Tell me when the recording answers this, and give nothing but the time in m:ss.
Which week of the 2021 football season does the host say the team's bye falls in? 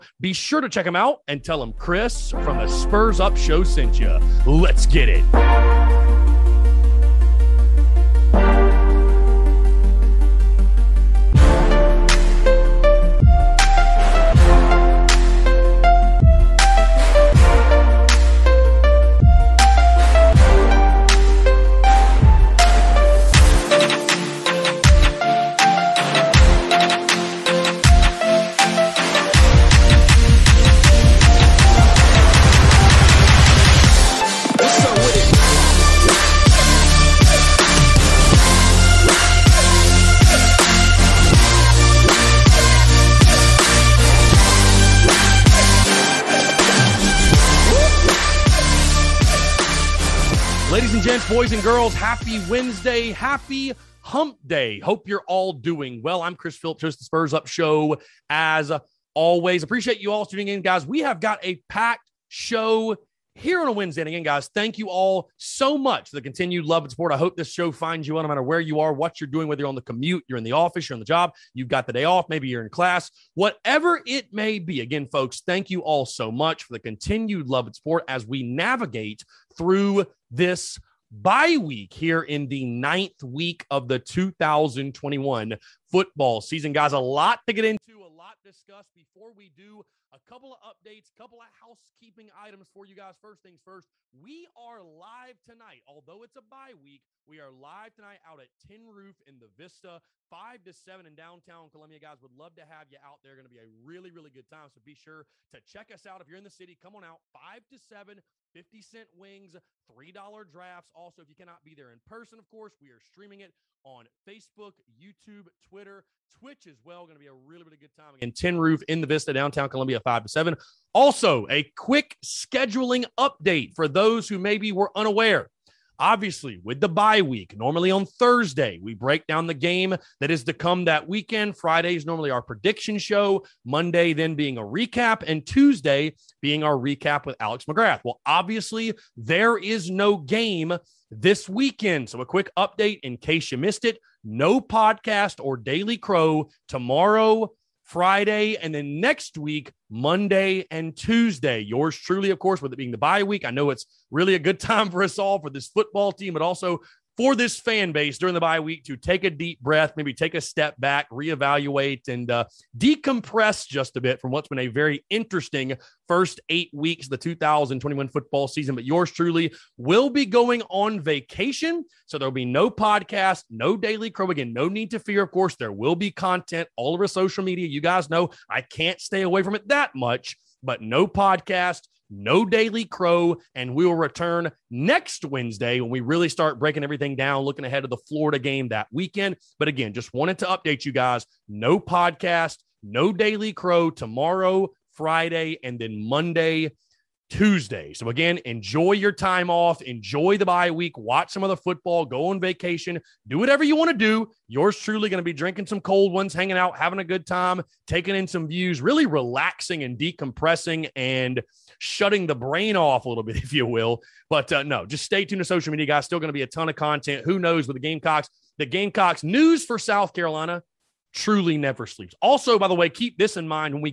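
1:22.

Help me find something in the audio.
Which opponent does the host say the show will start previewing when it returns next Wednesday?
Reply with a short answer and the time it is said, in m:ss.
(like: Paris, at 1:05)
Florida, at 3:08.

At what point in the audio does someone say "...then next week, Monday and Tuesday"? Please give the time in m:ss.
2:28.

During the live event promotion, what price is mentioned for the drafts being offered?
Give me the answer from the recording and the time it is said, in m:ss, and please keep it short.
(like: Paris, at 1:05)
$3, at 1:49.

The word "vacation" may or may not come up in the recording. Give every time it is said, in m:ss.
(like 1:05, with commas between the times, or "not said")
2:50, 3:22.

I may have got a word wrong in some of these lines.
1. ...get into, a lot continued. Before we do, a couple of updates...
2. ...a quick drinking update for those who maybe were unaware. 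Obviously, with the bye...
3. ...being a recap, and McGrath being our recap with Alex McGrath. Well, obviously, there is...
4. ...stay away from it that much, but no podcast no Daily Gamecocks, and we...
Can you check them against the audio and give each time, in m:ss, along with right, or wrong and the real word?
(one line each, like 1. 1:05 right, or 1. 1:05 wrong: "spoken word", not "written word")
1. 1:27 wrong: "discussed", not "continued"
2. 2:01 wrong: "scheduling", not "drinking"
3. 2:14 wrong: "Tuesday", not "McGrath"
4. 2:58 wrong: "Crow", not "Gamecocks".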